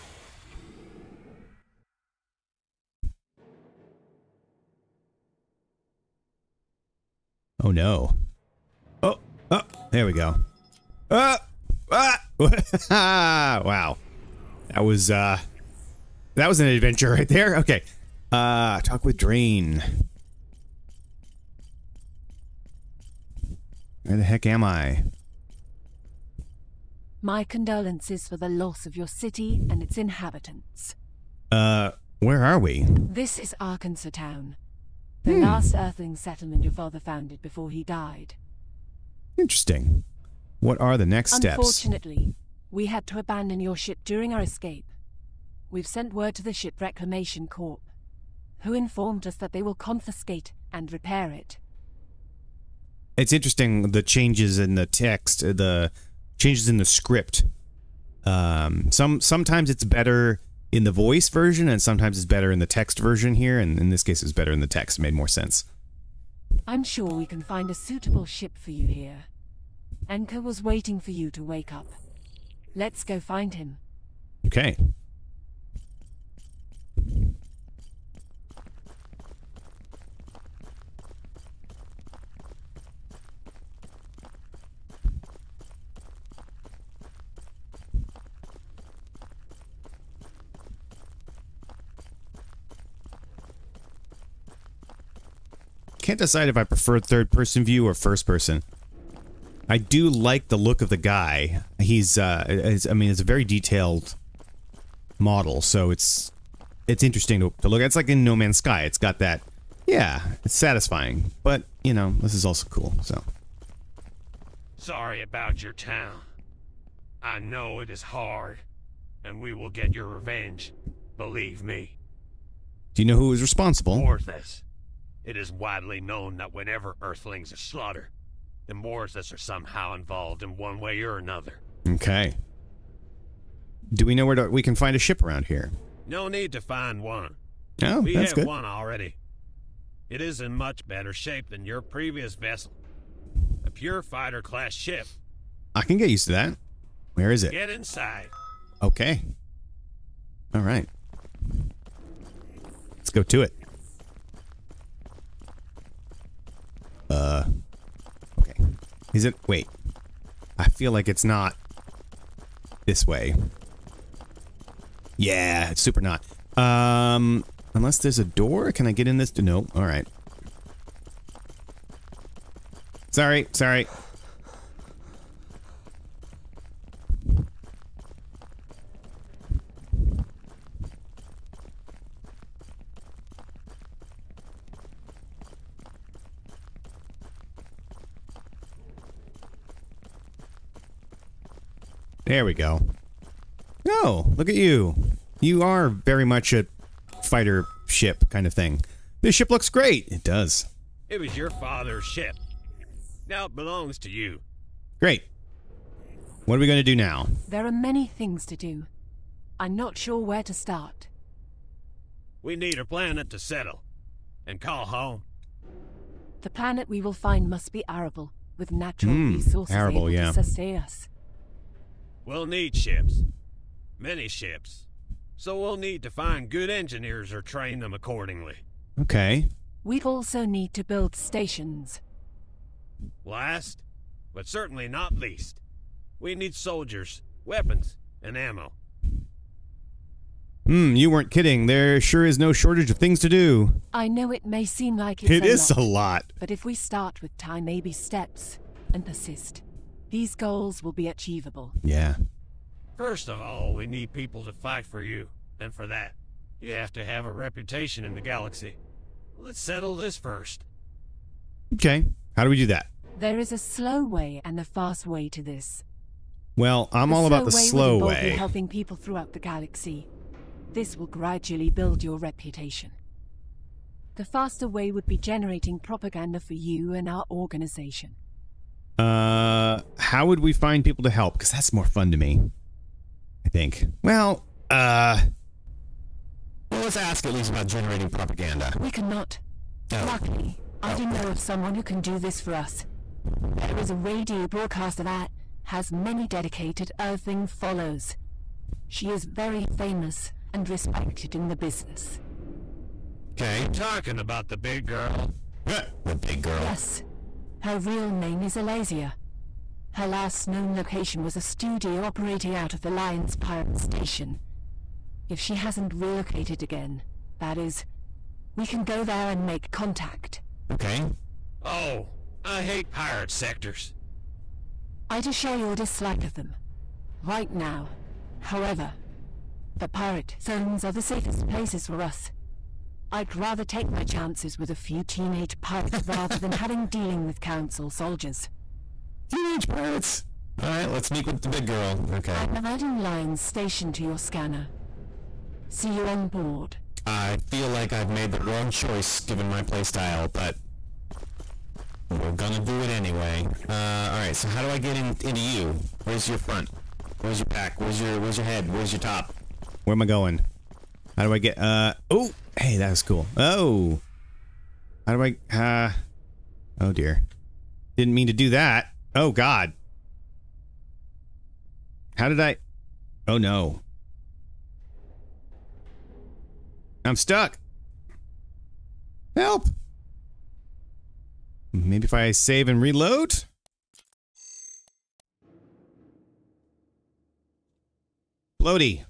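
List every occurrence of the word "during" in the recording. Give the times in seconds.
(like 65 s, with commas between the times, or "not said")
44 s.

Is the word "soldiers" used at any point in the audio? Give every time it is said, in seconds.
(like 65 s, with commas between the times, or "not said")
236 s, 337 s.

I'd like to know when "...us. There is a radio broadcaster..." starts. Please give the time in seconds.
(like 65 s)
292 s.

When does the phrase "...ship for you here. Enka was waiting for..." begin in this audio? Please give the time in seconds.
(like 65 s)
68 s.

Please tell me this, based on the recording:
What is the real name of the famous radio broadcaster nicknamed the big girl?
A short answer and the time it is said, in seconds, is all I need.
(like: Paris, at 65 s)
Alasia, at 308 s.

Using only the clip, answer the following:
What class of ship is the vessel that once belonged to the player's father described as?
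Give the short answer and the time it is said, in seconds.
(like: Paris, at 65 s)
pure fighter class, at 143 s.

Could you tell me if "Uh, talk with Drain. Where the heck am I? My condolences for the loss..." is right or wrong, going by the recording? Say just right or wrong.
right.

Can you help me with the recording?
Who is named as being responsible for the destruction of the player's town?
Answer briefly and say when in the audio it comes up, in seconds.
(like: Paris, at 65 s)
Orthus, at 124 s.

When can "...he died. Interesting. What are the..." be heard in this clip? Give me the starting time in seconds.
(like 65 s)
37 s.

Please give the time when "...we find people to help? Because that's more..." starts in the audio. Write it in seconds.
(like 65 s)
280 s.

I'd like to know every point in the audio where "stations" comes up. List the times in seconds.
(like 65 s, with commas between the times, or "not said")
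231 s, 313 s, 343 s.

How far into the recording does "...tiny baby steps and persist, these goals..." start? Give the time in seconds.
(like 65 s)
247 s.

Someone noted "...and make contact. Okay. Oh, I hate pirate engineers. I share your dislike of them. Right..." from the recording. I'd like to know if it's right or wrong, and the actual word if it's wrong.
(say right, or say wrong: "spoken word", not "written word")
wrong: "sectors", not "engineers".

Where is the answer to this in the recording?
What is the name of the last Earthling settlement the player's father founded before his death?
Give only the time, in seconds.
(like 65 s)
33 s.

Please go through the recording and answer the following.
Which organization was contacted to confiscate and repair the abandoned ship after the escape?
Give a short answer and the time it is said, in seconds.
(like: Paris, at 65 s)
Ship Reclamation Corp, at 46 s.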